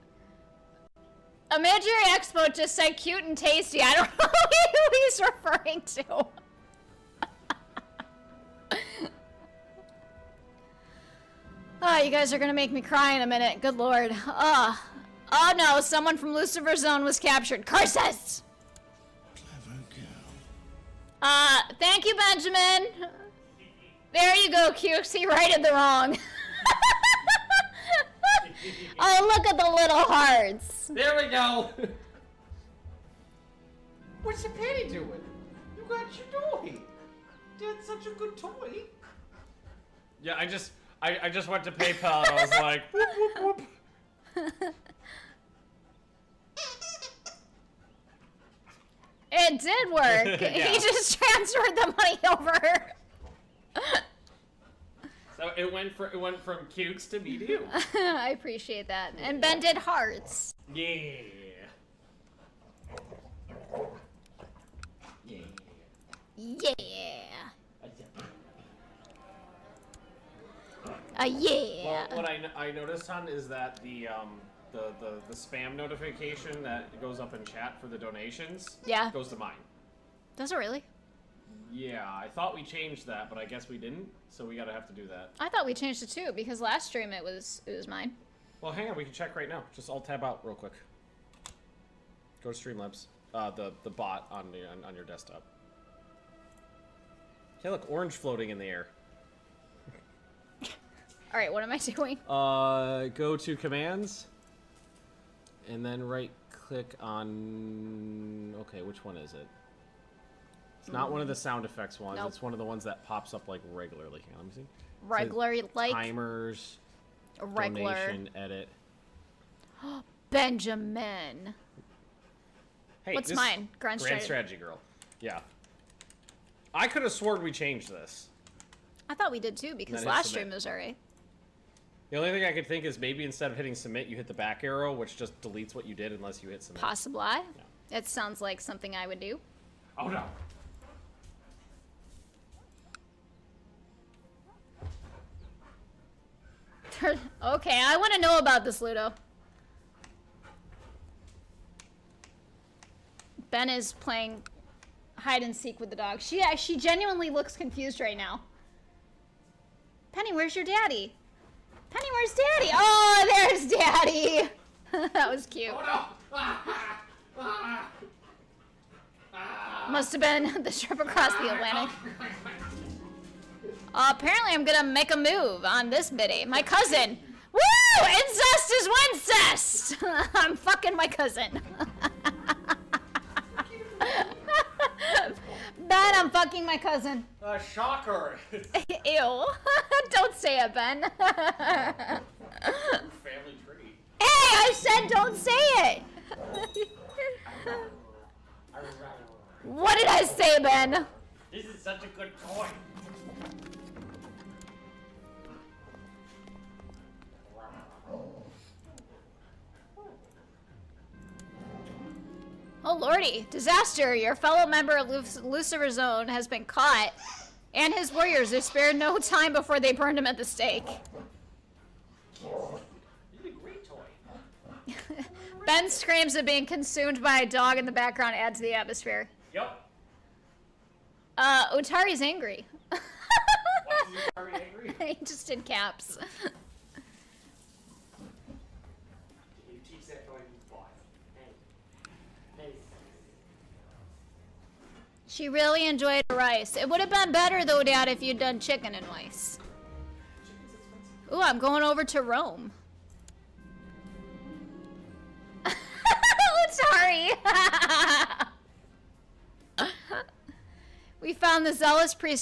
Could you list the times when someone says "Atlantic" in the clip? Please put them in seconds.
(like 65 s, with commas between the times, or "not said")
171 s.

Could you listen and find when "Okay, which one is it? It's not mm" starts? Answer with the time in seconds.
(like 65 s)
108 s.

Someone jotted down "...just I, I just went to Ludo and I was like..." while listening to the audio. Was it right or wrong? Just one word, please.
wrong.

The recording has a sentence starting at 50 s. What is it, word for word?
He just transferred the money over.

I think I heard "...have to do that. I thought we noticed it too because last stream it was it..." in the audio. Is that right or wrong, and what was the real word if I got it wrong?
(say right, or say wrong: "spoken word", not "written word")
wrong: "changed", not "noticed".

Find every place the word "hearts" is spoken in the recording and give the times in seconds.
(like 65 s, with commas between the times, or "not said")
29 s, 59 s.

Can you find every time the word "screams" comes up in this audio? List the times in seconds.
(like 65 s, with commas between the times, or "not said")
225 s.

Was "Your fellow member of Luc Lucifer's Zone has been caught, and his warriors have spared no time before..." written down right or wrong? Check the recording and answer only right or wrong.
right.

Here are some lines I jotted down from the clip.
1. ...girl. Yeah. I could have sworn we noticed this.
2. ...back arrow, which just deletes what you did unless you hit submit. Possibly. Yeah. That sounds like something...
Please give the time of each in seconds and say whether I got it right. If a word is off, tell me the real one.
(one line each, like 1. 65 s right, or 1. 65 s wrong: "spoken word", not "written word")
1. 124 s wrong: "changed", not "noticed"
2. 134 s right.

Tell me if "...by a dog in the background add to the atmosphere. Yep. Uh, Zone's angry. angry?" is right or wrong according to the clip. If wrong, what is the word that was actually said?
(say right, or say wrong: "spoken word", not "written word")
wrong: "Otari", not "Zone".